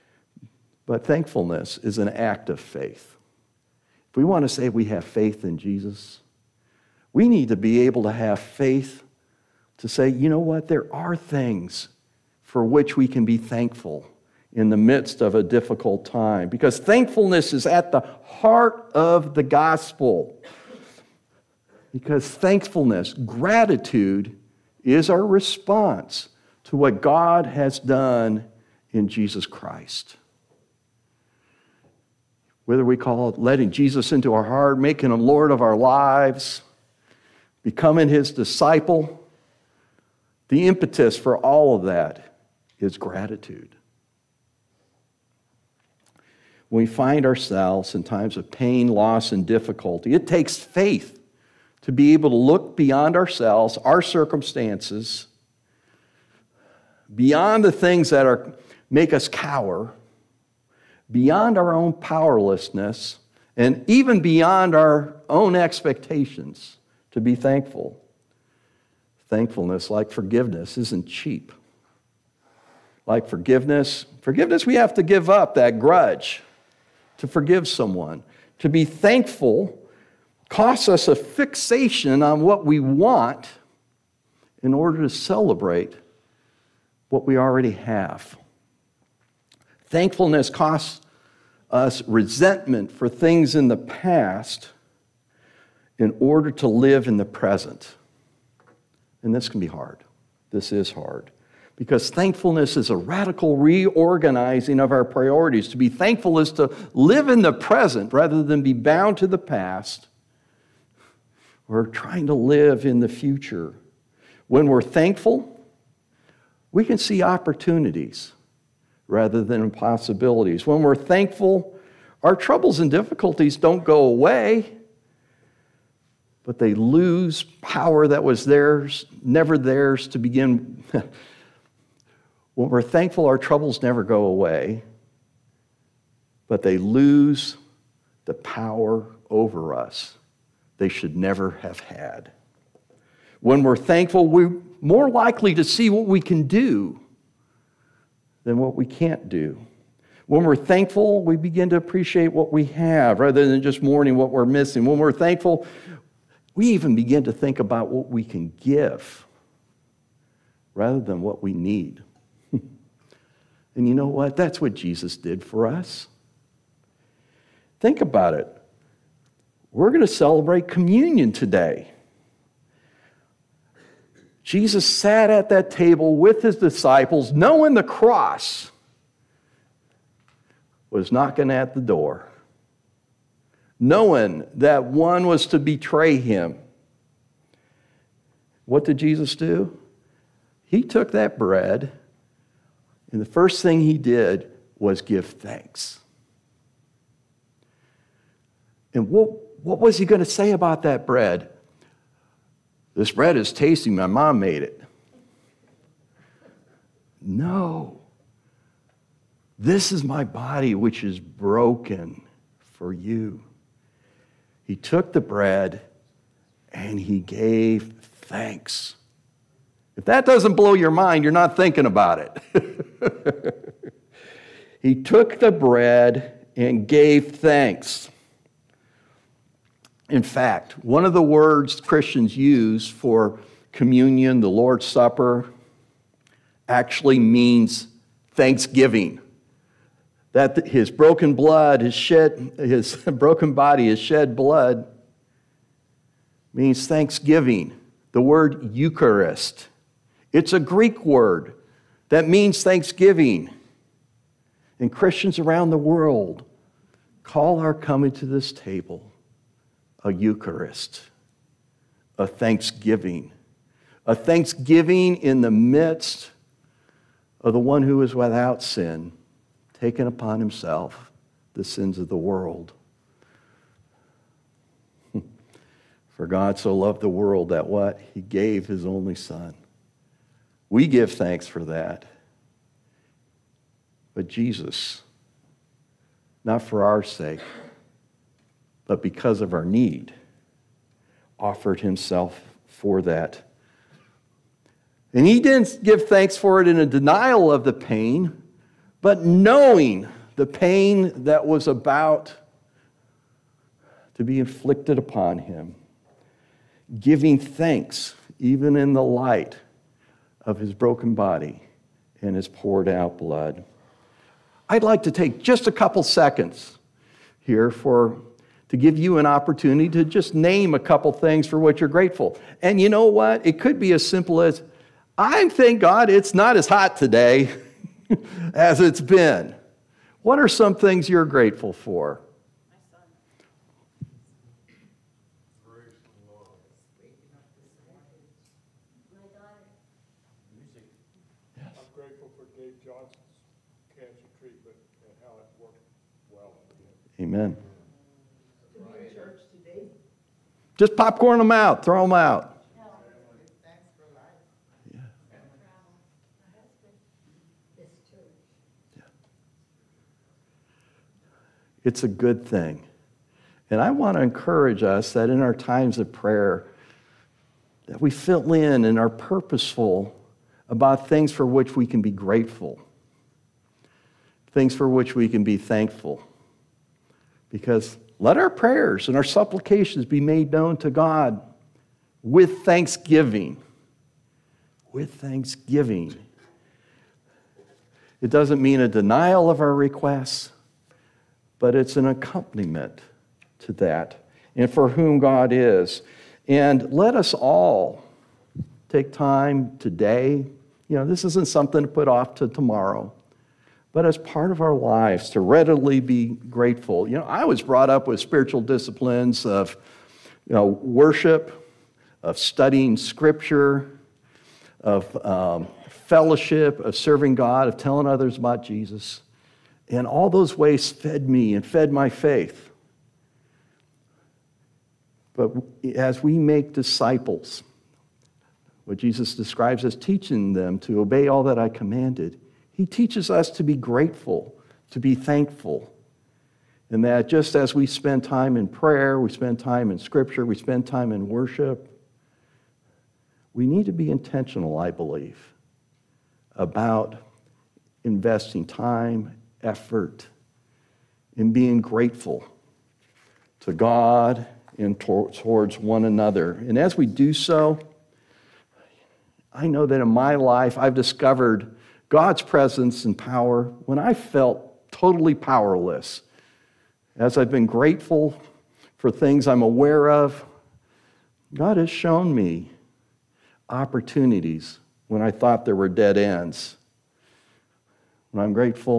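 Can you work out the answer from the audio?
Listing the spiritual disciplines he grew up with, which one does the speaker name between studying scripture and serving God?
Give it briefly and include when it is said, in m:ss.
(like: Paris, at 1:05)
Fellowship, at 6:55.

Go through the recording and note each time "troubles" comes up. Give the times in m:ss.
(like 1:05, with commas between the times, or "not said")
2:02, 2:13.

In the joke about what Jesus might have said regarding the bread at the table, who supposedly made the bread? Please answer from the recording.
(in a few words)
My mom.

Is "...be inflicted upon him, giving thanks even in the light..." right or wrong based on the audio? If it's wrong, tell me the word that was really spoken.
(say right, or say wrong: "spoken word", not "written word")
right.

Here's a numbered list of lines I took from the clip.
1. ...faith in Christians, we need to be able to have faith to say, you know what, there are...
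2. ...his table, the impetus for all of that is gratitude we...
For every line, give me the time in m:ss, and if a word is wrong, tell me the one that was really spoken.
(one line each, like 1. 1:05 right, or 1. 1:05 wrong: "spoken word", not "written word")
1. 0:05 wrong: "Jesus", not "Christians"
2. 0:38 wrong: "disciple", not "table".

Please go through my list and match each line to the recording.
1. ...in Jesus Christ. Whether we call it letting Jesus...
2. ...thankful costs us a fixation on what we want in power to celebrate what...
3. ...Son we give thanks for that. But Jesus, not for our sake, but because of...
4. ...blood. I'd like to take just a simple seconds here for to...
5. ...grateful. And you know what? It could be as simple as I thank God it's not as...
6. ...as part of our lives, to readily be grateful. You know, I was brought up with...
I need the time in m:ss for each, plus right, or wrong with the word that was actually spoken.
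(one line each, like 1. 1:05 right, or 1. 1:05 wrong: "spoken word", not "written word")
1. 0:28 right
2. 1:18 wrong: "order", not "power"
3. 4:39 right
4. 5:13 wrong: "couple", not "simple"
5. 5:21 right
6. 6:44 right.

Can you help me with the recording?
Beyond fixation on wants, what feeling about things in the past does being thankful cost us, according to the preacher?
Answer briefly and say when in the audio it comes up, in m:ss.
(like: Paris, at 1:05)
Resentment, at 1:32.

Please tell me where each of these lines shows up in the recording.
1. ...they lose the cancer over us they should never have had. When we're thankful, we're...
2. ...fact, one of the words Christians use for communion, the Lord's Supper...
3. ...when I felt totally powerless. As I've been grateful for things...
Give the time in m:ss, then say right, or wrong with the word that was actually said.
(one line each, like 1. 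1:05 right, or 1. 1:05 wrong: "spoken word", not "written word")
1. 2:16 wrong: "power", not "cancer"
2. 3:50 right
3. 7:43 right.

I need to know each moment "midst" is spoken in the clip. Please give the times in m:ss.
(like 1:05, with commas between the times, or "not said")
0:14, 4:25.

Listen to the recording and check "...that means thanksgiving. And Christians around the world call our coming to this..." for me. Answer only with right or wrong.
right.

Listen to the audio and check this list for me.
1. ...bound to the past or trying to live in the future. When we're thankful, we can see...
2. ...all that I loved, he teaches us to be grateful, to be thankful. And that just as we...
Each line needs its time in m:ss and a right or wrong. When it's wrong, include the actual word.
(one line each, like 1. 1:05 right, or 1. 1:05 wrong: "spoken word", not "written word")
1. 1:48 right
2. 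7:11 wrong: "commanded", not "loved".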